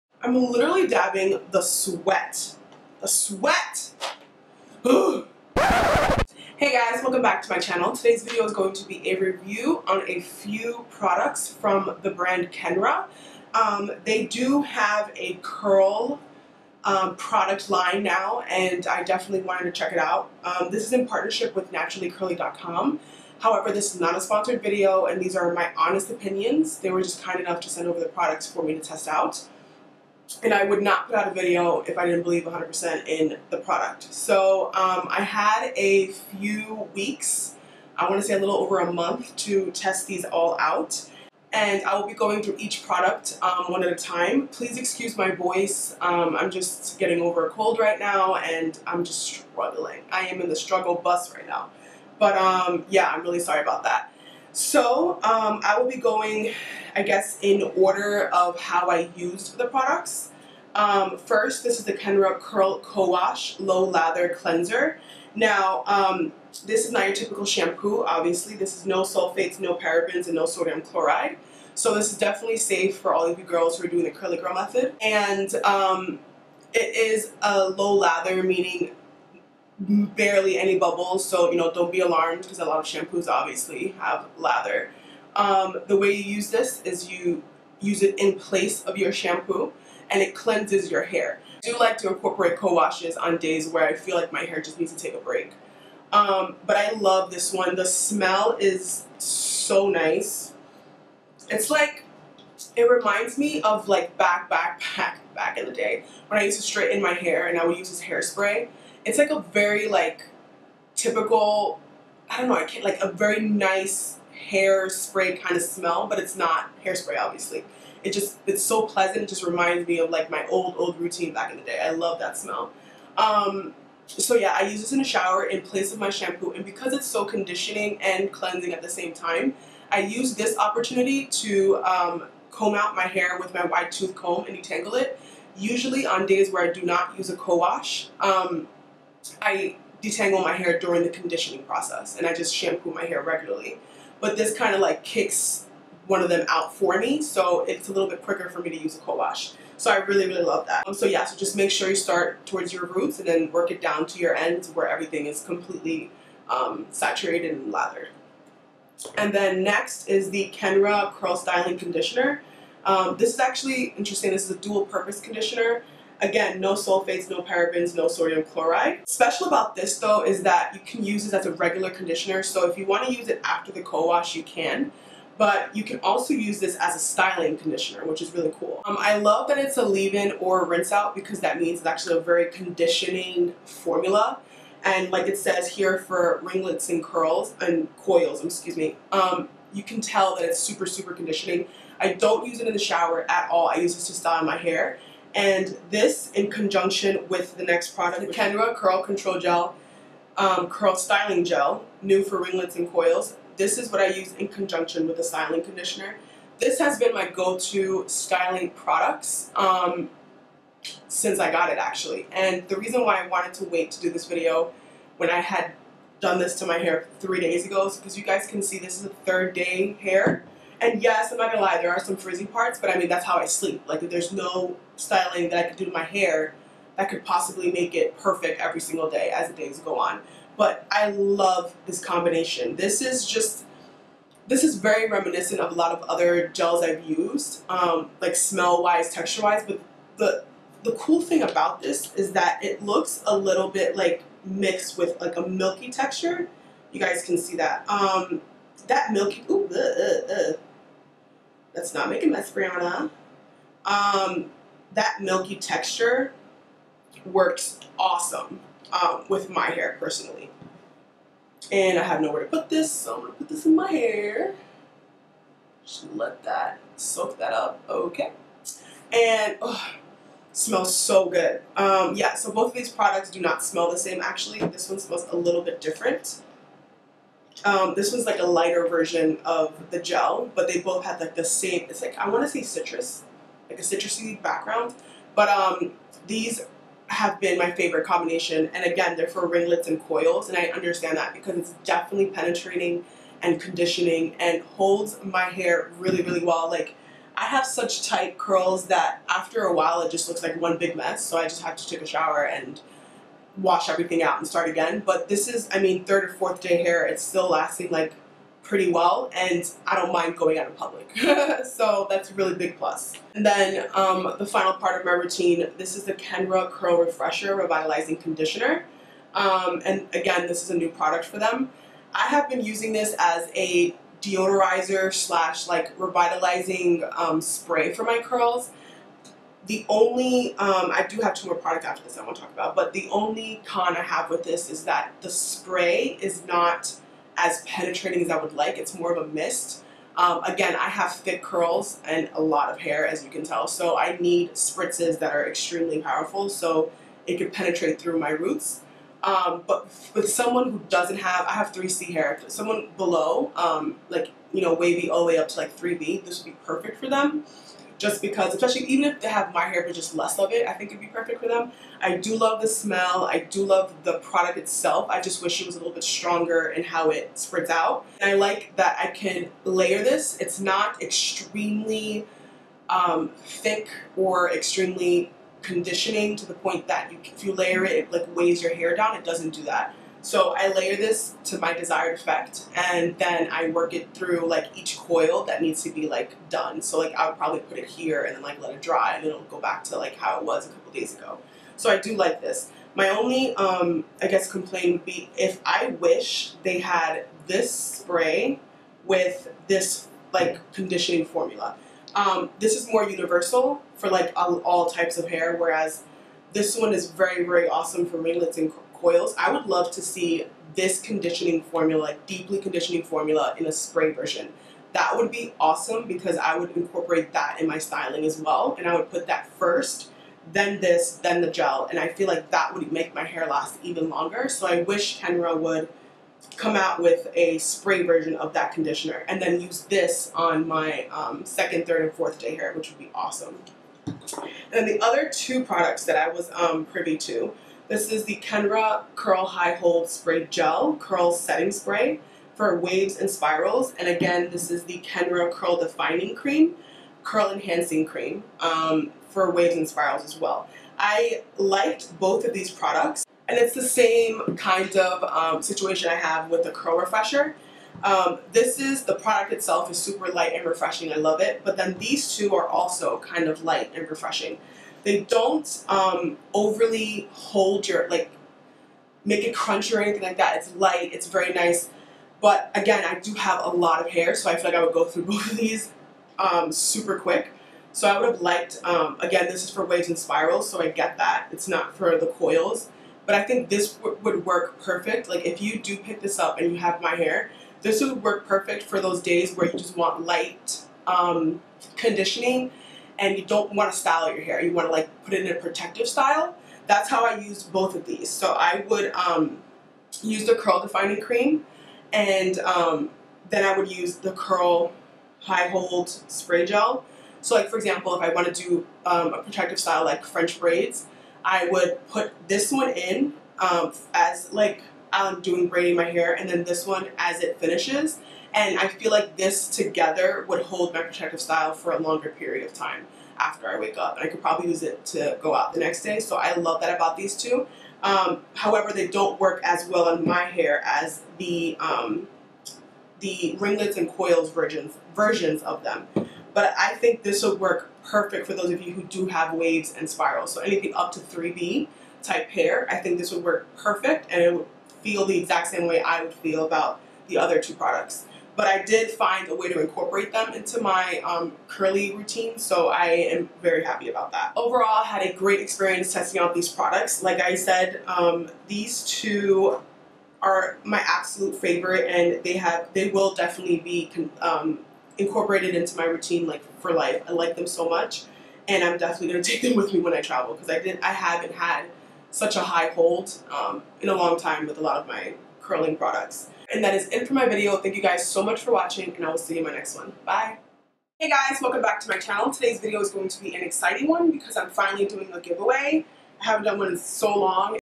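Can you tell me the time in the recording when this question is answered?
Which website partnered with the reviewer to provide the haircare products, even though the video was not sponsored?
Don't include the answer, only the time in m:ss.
0:21.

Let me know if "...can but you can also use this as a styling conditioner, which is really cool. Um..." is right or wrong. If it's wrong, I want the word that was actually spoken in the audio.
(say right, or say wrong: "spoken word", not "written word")
right.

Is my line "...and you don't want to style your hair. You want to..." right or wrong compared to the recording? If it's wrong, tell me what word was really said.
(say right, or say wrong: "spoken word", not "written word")
right.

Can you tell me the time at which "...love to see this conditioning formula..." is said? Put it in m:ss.
6:49.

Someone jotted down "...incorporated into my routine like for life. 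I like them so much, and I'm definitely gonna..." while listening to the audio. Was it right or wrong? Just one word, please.
right.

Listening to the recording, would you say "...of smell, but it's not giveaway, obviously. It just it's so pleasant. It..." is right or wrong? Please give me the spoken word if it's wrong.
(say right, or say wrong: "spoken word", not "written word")
wrong: "hairspray", not "giveaway".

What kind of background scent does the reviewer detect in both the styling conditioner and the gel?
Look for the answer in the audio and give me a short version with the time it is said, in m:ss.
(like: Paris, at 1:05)
citrusy, at 4:43.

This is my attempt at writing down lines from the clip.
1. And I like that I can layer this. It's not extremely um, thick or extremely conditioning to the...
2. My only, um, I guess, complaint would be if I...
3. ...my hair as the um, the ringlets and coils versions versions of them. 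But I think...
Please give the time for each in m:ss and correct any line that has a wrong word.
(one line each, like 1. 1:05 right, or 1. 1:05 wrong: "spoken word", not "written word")
1. 6:08 right
2. 6:32 right
3. 8:50 right.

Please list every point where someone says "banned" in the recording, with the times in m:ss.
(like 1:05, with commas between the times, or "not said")
not said.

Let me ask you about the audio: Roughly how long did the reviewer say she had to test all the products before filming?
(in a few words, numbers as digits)
a little over a month.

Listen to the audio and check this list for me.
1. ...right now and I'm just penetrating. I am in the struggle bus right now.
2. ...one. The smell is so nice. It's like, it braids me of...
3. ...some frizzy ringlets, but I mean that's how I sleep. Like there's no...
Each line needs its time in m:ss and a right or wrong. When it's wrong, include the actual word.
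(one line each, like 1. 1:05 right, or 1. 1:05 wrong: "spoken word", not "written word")
1. 0:47 wrong: "struggling", not "penetrating"
2. 1:37 wrong: "reminds", not "braids"
3. 3:42 wrong: "parts", not "ringlets".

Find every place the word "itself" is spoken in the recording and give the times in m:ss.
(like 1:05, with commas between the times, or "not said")
6:04, 7:39.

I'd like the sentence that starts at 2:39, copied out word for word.
And then next is the Kenra Curl Styling Conditioner.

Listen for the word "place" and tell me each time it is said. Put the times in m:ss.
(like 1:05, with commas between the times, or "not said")
1:28, 2:05.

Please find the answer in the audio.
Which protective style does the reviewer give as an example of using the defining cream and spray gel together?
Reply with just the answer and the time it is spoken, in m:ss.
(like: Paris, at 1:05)
French braids, at 8:30.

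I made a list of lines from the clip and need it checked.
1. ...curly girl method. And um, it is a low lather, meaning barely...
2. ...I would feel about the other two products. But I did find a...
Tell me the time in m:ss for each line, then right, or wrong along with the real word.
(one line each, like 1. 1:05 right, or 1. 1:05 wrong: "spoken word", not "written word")
1. 1:14 right
2. 9:06 right.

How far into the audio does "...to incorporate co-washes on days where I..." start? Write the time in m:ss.
1:31.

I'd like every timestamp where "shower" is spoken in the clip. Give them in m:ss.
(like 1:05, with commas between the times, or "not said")
2:05, 3:12, 5:02.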